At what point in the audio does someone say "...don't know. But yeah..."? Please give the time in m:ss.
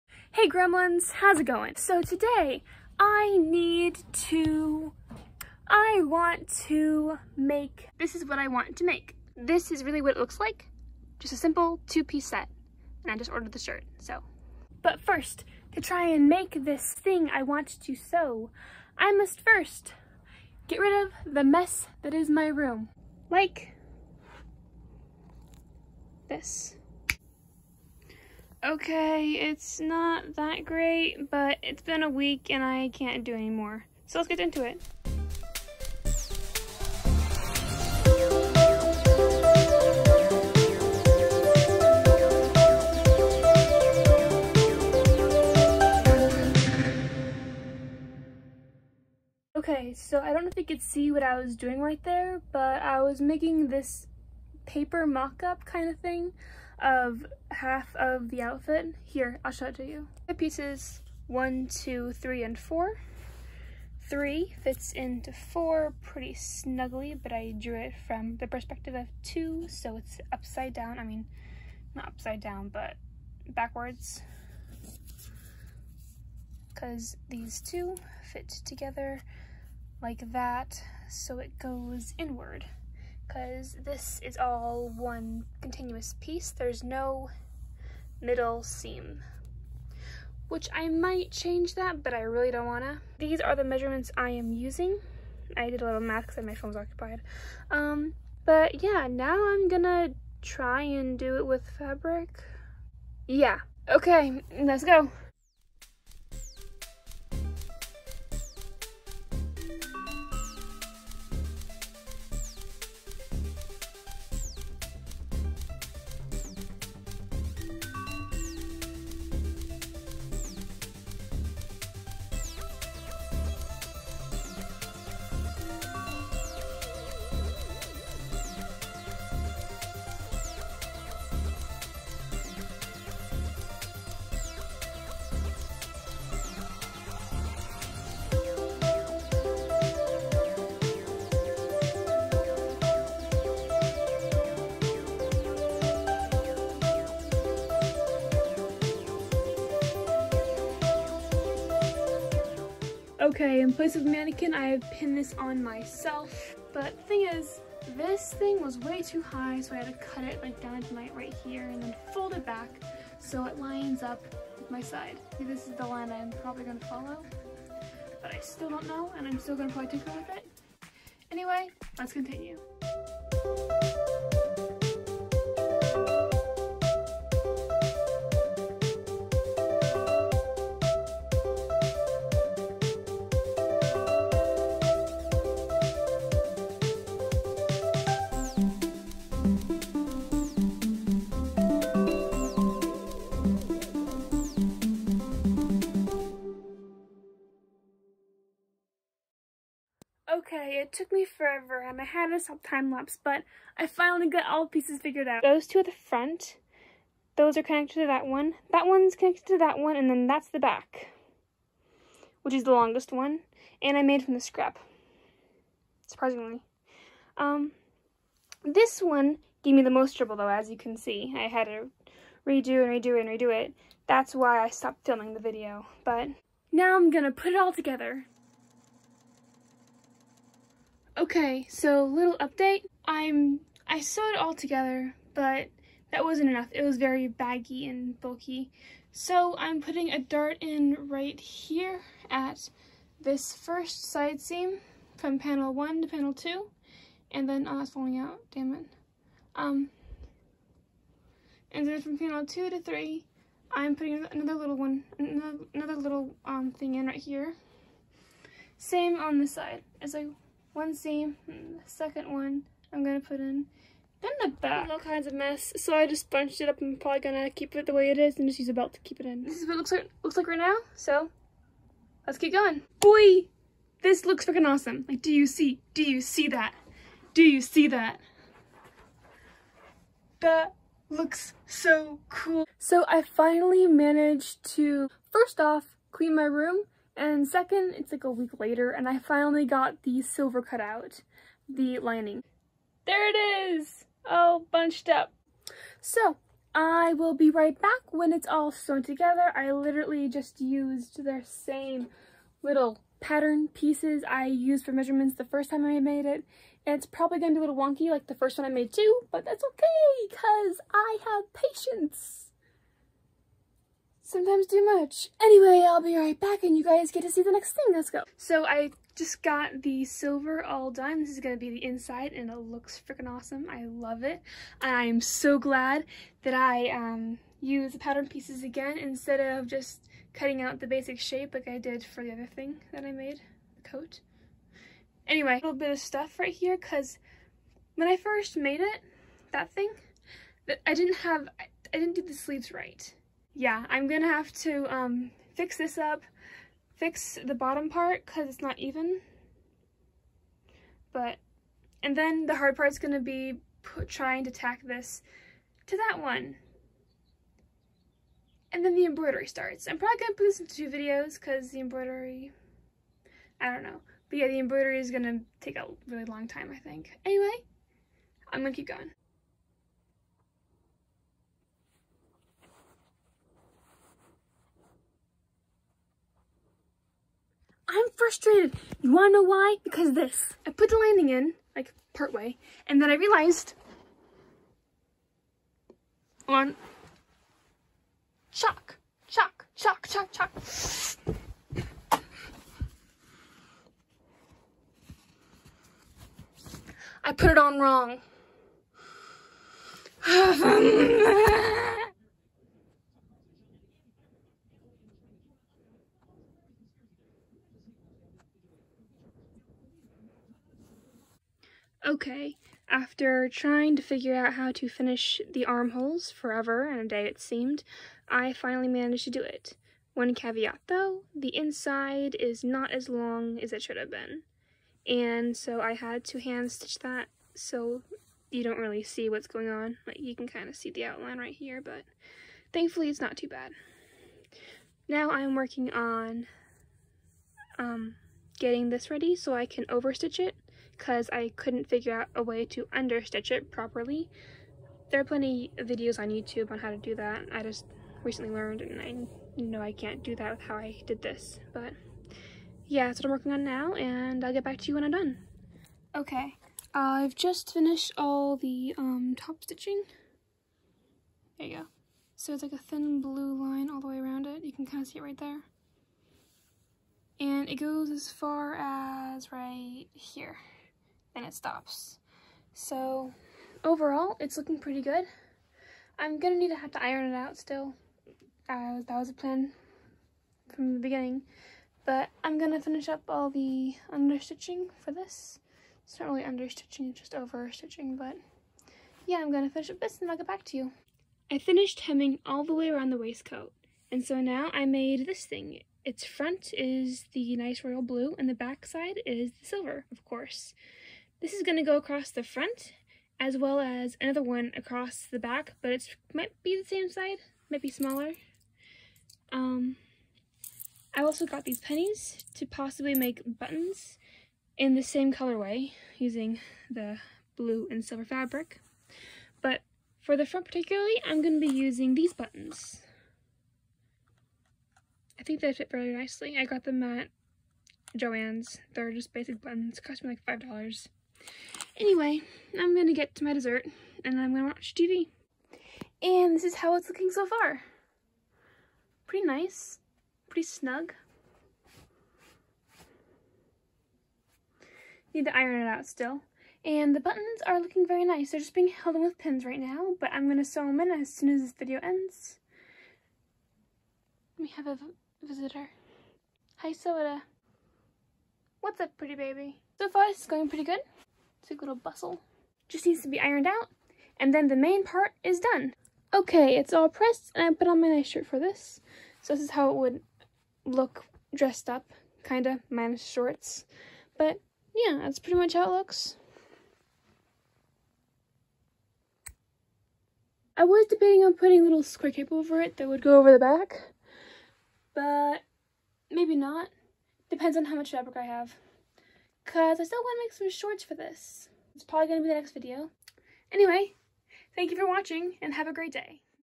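6:03.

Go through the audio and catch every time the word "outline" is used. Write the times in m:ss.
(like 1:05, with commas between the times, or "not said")
7:11.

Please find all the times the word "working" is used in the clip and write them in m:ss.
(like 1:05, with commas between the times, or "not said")
7:15, 7:33.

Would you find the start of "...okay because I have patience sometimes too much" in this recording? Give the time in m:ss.
5:09.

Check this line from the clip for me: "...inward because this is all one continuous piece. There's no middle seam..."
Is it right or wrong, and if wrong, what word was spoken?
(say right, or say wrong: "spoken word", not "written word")
right.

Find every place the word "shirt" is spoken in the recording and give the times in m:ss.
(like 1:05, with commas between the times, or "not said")
0:13, 9:28.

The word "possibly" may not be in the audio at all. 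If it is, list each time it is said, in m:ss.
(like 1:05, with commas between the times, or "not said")
8:32.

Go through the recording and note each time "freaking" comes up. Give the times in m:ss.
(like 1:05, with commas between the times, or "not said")
4:34, 5:23.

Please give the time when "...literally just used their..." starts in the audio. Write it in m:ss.
4:59.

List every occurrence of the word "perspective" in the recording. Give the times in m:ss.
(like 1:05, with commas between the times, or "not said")
1:08.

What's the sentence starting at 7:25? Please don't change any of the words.
There are plenty of videos on YouTube on how to do that.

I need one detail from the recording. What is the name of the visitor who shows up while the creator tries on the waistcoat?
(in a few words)
Soda.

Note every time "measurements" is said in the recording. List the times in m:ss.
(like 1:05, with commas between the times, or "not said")
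1:33, 5:04.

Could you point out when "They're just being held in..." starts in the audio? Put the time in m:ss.
9:08.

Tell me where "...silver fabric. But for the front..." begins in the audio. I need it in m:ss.
8:38.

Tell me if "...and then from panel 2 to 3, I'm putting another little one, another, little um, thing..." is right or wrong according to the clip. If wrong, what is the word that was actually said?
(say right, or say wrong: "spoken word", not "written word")
right.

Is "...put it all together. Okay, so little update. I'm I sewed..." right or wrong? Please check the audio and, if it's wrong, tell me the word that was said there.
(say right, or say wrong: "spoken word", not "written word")
right.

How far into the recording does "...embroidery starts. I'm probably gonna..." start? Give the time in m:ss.
5:59.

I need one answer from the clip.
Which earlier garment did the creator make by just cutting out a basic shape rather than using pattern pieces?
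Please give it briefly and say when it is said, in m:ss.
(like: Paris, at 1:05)
The coat, at 5:33.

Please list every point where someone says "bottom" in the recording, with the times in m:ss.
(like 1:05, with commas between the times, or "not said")
5:47.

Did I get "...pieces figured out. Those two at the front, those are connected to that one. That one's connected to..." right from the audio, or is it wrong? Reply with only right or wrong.
right.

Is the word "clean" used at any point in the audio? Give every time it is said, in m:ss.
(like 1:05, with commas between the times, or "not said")
4:46.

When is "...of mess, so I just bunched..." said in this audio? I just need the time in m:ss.
4:25.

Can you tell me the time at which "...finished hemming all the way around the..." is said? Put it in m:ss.
8:11.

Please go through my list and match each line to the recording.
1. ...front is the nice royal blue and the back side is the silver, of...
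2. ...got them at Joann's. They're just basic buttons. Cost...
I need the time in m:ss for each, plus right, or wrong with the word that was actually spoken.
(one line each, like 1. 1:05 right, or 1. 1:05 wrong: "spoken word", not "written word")
1. 8:16 right
2. 8:46 right.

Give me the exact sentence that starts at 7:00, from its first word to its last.
One caveat though, the inside is not as long as it should have been.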